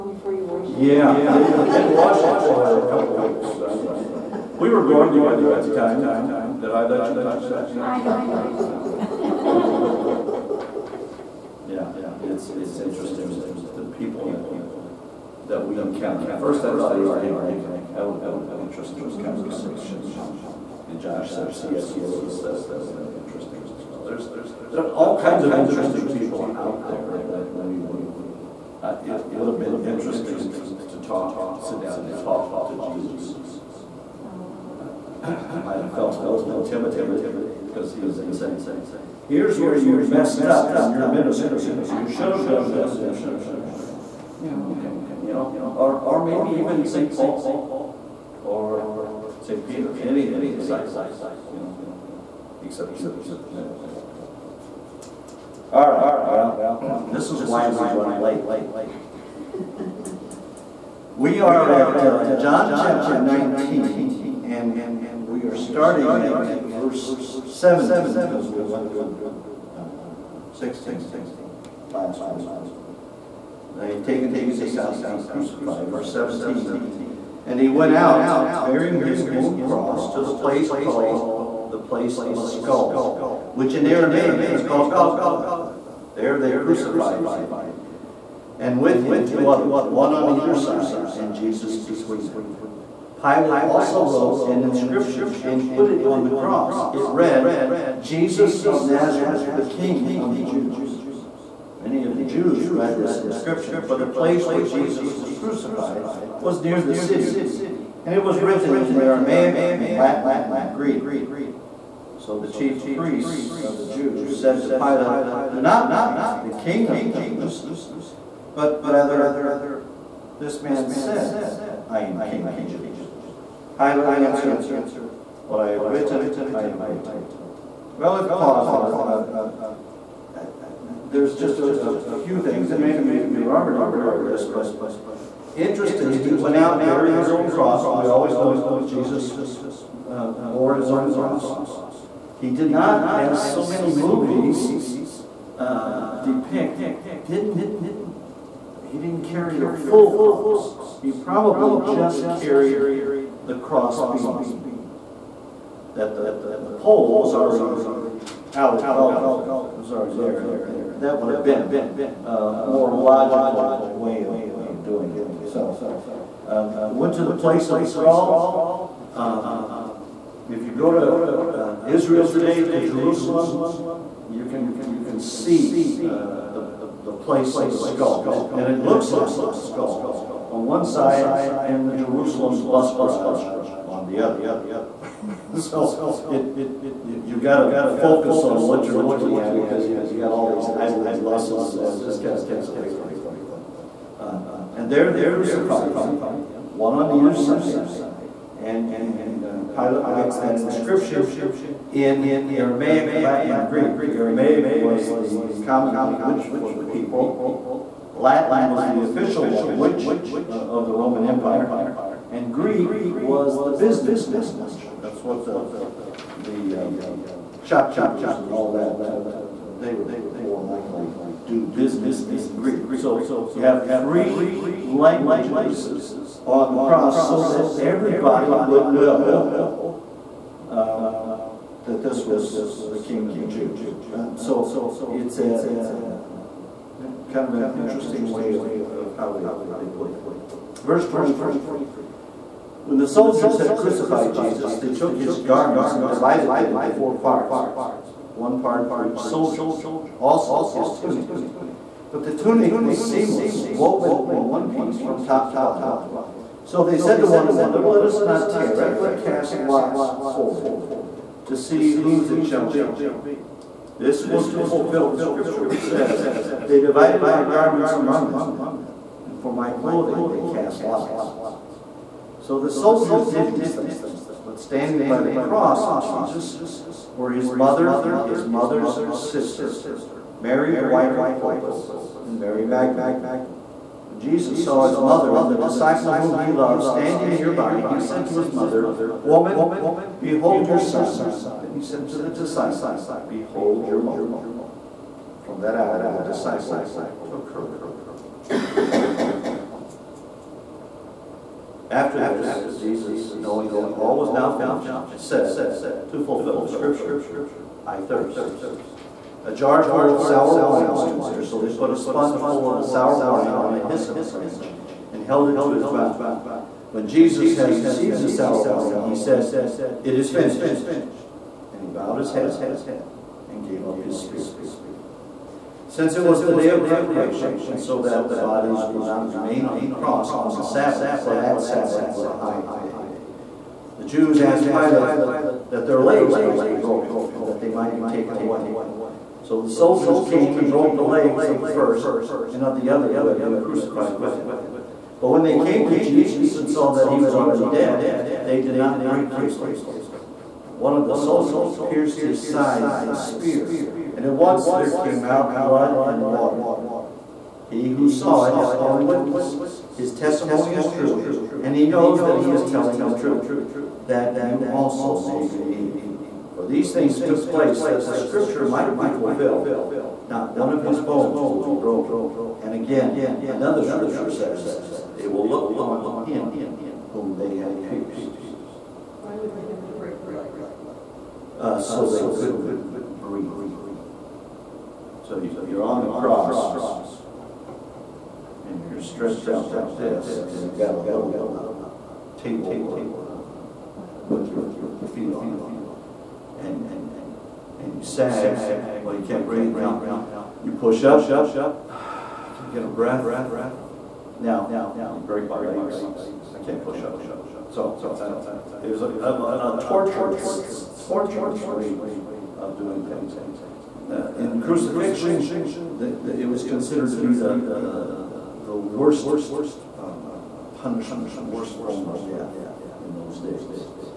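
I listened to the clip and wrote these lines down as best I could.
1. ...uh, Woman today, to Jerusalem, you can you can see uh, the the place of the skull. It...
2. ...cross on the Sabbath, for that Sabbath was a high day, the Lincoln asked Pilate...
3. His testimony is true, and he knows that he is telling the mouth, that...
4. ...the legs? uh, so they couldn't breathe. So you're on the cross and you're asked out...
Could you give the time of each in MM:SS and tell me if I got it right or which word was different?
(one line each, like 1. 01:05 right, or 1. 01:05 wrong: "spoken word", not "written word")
1. 02:51 wrong: "Israel", not "Woman"
2. 05:29 wrong: "Jews", not "Lincoln"
3. 05:59 wrong: "truth", not "mouth"
4. 06:20 wrong: "stretched", not "asked".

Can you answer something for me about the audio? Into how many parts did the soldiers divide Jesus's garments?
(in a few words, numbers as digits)
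4.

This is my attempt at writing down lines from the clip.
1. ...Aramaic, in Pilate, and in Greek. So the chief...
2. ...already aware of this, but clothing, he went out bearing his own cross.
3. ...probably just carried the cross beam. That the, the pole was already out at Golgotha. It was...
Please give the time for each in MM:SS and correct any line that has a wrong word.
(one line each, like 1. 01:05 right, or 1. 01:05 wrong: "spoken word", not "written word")
1. 01:48 wrong: "Latin", not "Pilate"
2. 02:13 wrong: "interesting", not "clothing"
3. 02:31 right.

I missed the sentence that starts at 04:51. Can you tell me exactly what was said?
Then he said to the disciple, Behold your mother.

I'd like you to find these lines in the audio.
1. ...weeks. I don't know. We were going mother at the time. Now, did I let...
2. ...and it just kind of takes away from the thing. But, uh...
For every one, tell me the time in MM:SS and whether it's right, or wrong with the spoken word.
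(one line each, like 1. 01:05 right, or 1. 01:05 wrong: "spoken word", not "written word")
1. 00:03 wrong: "together", not "mother"
2. 03:11 right.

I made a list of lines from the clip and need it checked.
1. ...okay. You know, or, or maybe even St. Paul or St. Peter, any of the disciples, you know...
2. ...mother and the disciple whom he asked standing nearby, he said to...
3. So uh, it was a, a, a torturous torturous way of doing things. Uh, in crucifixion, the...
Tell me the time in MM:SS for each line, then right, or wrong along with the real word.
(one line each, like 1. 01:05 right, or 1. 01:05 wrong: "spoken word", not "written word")
1. 00:44 right
2. 04:44 wrong: "loved", not "asked"
3. 06:47 right.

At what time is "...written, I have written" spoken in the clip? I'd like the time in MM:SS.
02:05.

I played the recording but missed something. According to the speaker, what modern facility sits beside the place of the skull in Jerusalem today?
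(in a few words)
Jerusalem bus garage.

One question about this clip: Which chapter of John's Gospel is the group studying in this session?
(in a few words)
Chapter 19.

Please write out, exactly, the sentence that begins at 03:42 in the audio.
So you have three languages on the cross so that everybody would know this was the king of the Jews.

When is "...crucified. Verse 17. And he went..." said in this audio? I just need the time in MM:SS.
01:15.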